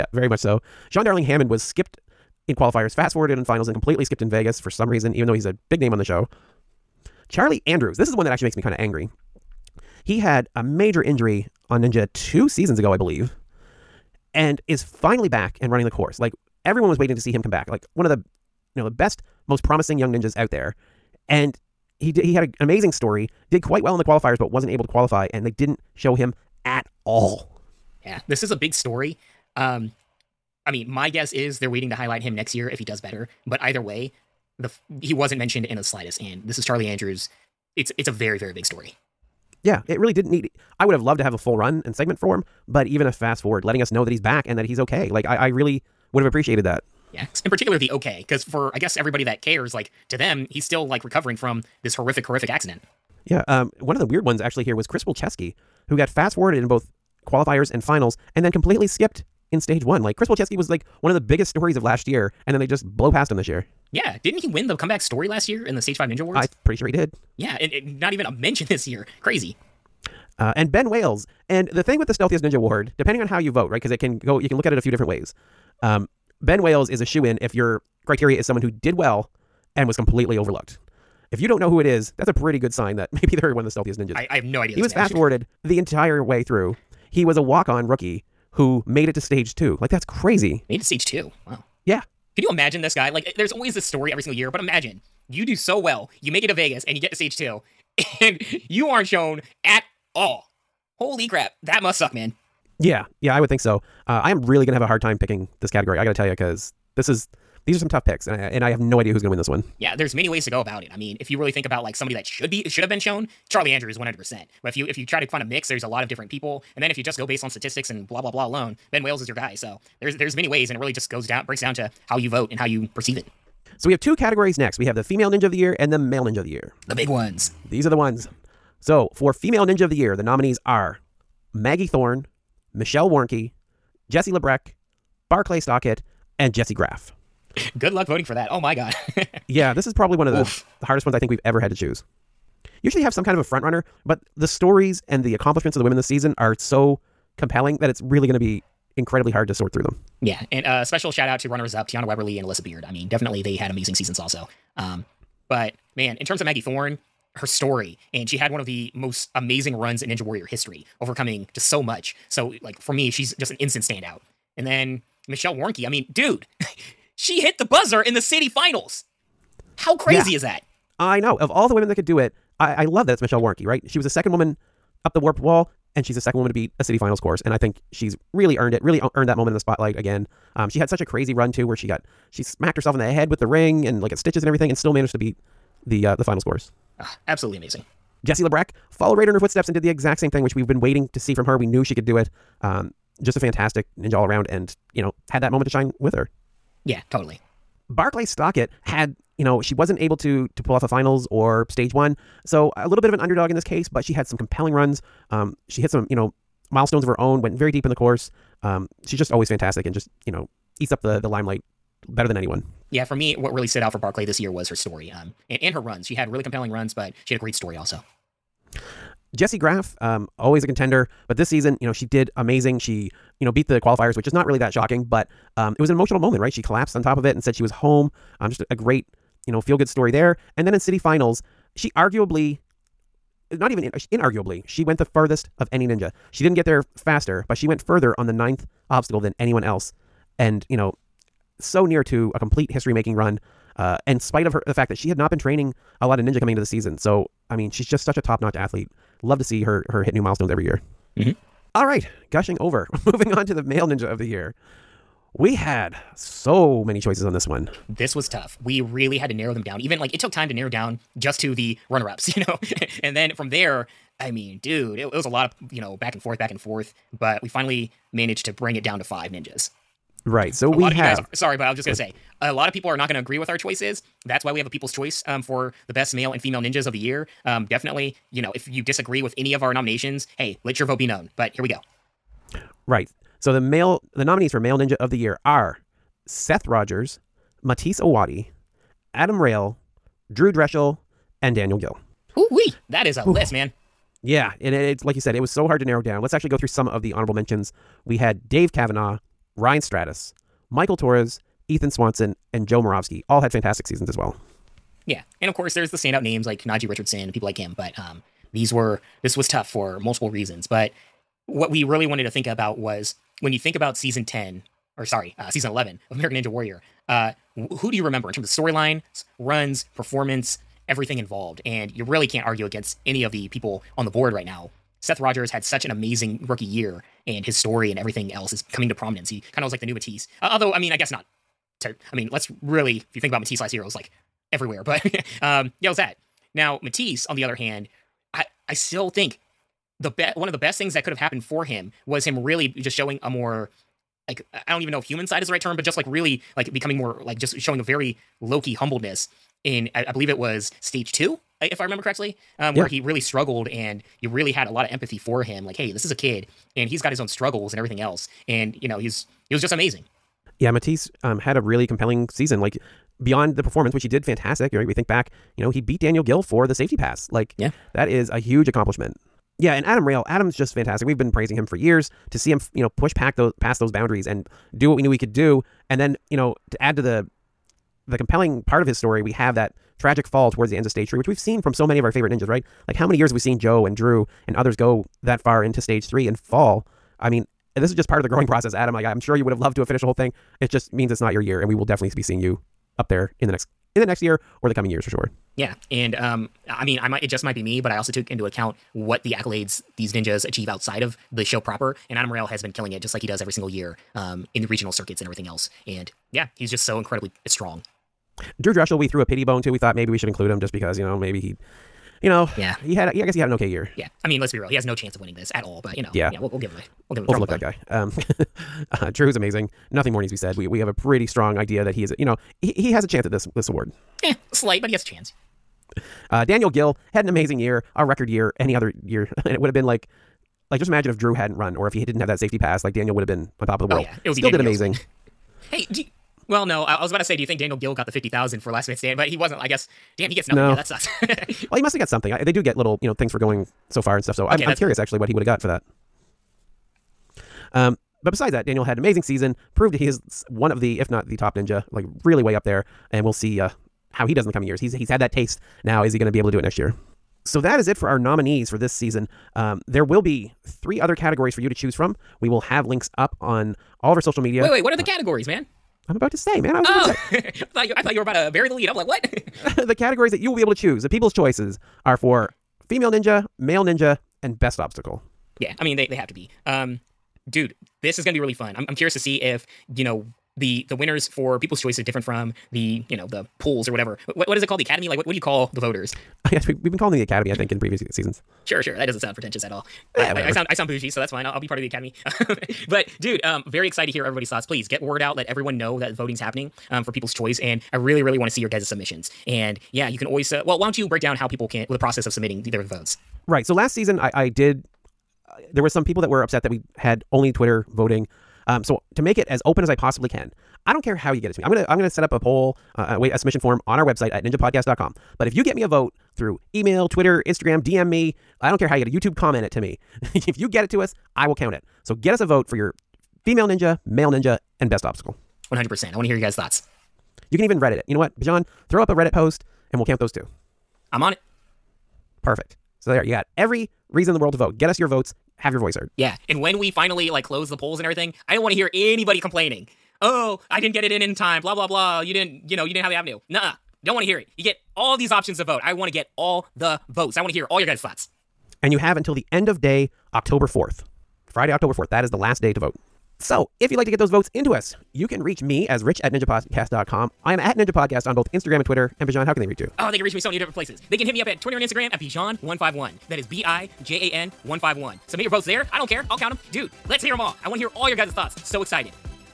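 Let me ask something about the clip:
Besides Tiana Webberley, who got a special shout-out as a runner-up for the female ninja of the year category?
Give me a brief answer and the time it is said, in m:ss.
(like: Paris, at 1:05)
Alyssa Beard, at 2:32.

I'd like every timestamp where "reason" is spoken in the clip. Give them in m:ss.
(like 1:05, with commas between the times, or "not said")
0:04, 5:10, 8:54.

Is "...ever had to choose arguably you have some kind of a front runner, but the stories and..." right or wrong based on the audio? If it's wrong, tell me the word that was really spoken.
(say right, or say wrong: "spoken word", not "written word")
wrong: "usually", not "arguably".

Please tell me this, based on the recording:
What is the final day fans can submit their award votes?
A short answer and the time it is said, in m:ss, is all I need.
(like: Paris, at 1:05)
Friday, October 4th, at 9:11.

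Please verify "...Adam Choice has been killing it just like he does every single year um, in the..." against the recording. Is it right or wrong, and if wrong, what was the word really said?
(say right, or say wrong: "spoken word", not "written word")
wrong: "Rayl", not "Choice".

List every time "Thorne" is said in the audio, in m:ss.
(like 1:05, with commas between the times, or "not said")
2:11, 2:36.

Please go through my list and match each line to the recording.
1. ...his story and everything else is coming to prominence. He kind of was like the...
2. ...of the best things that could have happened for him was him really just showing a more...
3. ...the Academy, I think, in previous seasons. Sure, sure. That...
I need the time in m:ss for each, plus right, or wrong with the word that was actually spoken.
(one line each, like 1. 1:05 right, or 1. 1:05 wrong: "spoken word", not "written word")
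1. 5:27 right
2. 5:40 right
3. 8:07 right.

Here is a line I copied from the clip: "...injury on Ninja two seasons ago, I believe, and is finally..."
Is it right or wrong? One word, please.
right.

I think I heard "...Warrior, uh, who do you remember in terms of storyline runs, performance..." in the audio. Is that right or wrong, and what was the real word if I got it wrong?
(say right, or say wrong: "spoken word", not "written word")
right.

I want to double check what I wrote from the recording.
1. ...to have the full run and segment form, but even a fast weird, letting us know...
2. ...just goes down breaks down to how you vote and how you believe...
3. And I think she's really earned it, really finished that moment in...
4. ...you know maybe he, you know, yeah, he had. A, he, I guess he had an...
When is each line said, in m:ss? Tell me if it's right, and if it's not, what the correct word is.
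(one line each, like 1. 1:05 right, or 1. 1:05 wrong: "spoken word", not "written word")
1. 0:41 wrong: "forward", not "weird"
2. 2:00 wrong: "perceive", not "believe"
3. 2:57 wrong: "earned", not "finished"
4. 6:50 right.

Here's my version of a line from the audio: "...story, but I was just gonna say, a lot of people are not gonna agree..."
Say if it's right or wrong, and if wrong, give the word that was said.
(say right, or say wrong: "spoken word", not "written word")
wrong: "sorry", not "story".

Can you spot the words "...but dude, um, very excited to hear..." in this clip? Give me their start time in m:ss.
8:12.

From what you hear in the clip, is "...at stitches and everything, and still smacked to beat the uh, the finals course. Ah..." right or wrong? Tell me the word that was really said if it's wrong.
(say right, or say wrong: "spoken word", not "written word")
wrong: "managed", not "smacked".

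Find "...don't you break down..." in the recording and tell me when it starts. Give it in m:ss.
8:20.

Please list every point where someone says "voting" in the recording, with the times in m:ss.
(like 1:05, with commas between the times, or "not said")
2:18, 8:16, 8:27.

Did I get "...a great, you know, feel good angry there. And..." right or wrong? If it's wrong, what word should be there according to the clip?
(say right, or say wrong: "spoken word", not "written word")
wrong: "story", not "angry".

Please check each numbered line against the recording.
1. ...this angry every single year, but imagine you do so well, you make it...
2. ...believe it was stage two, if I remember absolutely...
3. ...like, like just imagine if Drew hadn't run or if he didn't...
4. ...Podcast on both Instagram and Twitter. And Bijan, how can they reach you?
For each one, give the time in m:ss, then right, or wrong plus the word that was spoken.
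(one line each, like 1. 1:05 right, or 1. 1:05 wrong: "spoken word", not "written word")
1. 1:33 wrong: "story", not "angry"
2. 5:50 wrong: "correctly", not "absolutely"
3. 7:09 right
4. 9:17 right.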